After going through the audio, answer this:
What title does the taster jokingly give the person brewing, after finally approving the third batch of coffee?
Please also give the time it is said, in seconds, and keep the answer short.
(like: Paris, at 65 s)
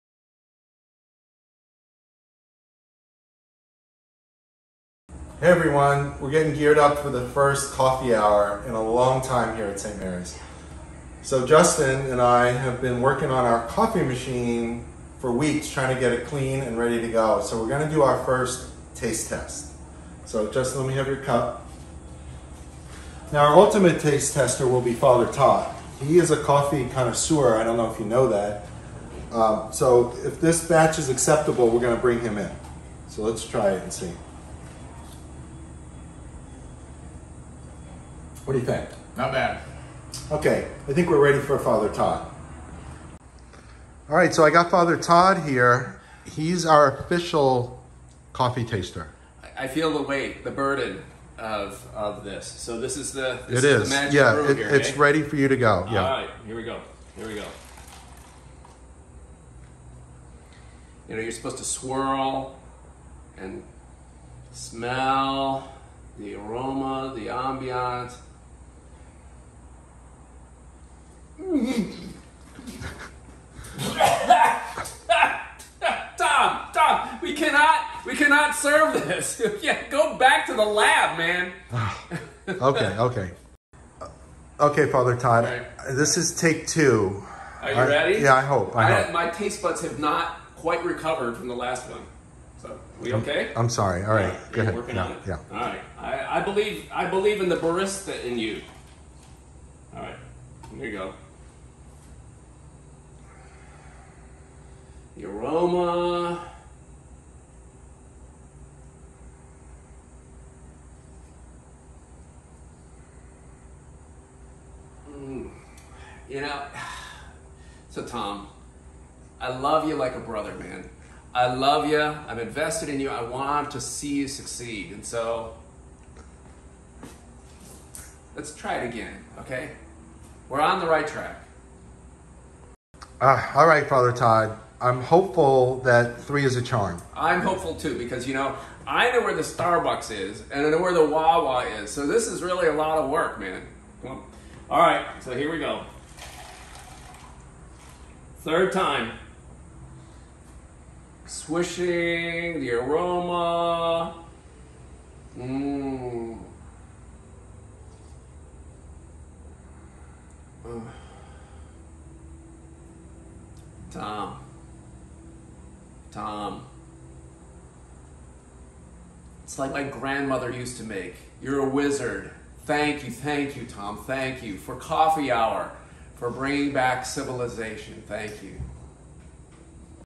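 A wizard, at 171 s.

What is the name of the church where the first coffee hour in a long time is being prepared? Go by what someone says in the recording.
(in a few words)
St. Mary's.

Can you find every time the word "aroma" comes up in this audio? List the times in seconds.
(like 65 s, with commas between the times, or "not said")
66 s, 105 s, 152 s.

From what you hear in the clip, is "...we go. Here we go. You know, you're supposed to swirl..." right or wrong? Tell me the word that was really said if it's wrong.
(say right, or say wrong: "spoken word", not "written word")
right.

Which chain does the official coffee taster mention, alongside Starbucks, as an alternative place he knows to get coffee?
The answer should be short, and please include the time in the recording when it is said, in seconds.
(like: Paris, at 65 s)
Wawa, at 141 s.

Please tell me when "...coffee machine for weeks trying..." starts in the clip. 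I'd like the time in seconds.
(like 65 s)
13 s.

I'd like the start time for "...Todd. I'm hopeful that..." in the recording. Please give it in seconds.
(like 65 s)
134 s.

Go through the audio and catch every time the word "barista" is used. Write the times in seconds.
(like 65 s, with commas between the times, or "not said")
97 s.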